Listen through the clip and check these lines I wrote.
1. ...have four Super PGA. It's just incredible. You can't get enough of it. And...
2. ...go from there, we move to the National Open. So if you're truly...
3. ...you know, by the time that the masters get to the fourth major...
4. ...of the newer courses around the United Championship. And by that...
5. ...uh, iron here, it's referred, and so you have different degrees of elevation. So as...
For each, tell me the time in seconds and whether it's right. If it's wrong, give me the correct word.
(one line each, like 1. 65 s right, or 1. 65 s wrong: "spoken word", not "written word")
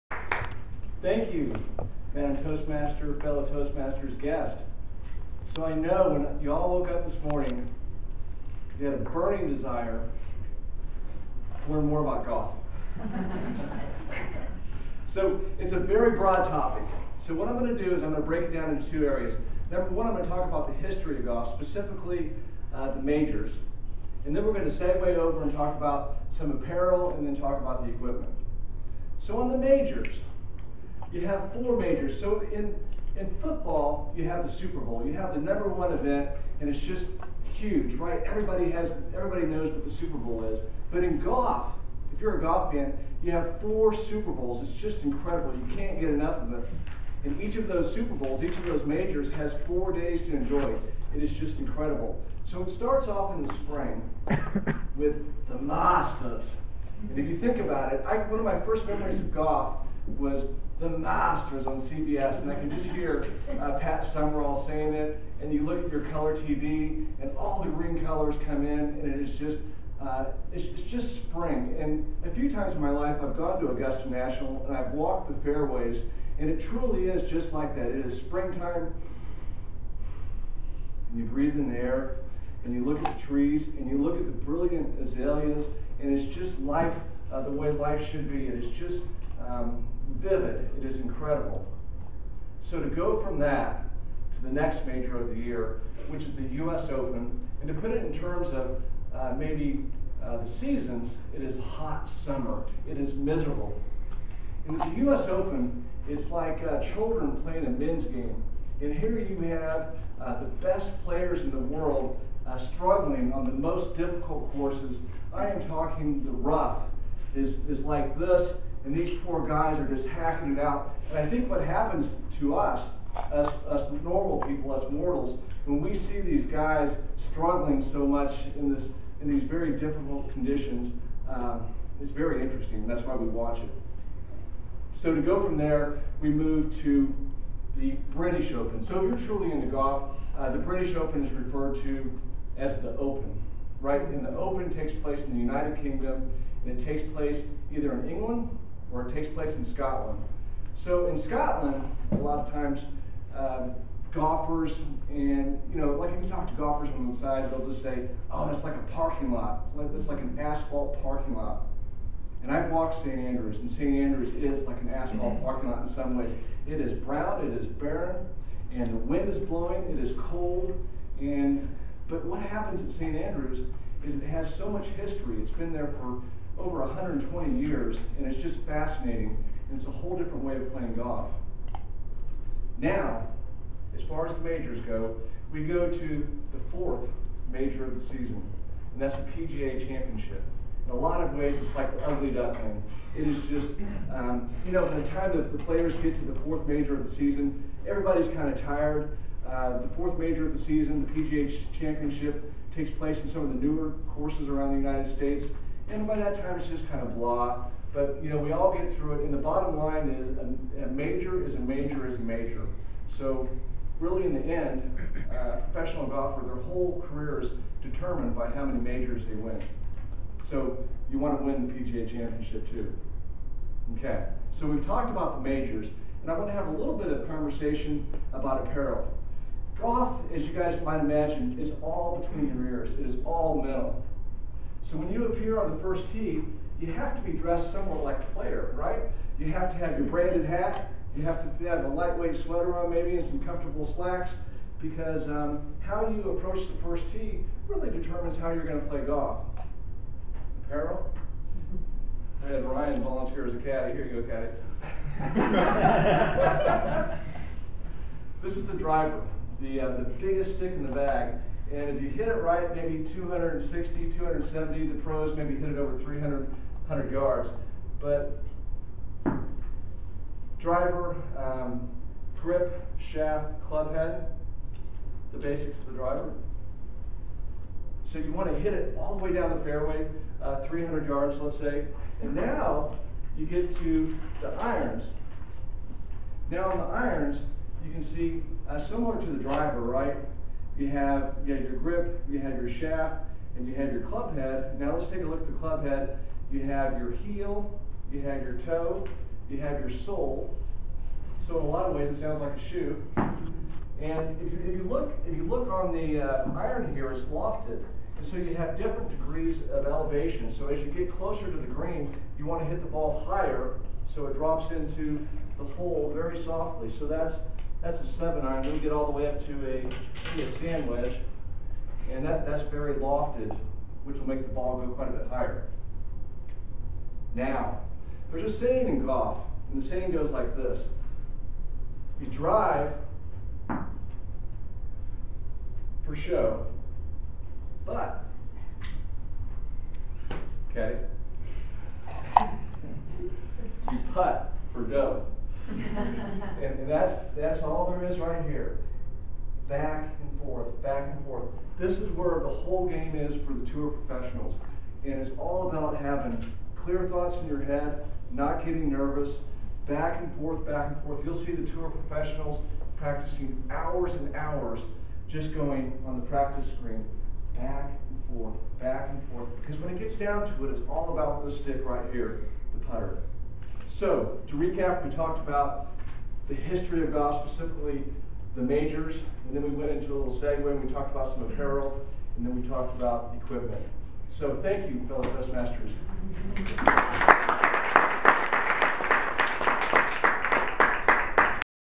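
1. 43 s wrong: "Bowls", not "PGA"
2. 135 s wrong: "British", not "National"
3. 194 s wrong: "players", not "masters"
4. 203 s wrong: "States", not "Championship"
5. 306 s wrong: "lofted", not "referred".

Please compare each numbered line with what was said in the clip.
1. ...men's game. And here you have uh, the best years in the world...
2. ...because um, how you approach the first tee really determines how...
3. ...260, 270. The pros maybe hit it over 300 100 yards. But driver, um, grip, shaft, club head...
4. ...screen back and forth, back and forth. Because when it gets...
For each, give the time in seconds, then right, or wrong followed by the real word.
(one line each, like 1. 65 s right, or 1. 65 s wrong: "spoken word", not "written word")
1. 107 s wrong: "players", not "years"
2. 244 s right
3. 263 s right
4. 366 s right.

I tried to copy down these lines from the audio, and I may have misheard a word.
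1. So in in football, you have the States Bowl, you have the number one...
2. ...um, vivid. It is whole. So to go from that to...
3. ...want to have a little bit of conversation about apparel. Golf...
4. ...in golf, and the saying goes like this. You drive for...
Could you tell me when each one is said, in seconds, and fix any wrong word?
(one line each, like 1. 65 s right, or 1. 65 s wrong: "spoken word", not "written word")
1. 32 s wrong: "Super", not "States"
2. 89 s wrong: "incredible", not "whole"
3. 226 s right
4. 328 s right.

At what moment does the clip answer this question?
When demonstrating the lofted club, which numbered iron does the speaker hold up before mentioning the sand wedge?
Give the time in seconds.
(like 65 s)
318 s.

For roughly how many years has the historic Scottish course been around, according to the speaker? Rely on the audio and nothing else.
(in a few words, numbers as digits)
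over 120 years.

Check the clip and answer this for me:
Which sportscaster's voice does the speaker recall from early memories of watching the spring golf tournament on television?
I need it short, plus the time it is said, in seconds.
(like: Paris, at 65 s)
Pat Summerall, at 63 s.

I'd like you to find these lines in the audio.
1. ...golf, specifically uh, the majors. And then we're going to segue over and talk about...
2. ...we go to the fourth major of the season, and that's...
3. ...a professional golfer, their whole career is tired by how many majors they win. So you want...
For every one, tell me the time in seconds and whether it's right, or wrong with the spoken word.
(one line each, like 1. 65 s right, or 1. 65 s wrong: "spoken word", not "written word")
1. 21 s right
2. 185 s right
3. 215 s wrong: "determined", not "tired".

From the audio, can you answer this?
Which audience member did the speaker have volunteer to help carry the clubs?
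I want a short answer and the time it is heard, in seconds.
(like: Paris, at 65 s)
Ryan, at 252 s.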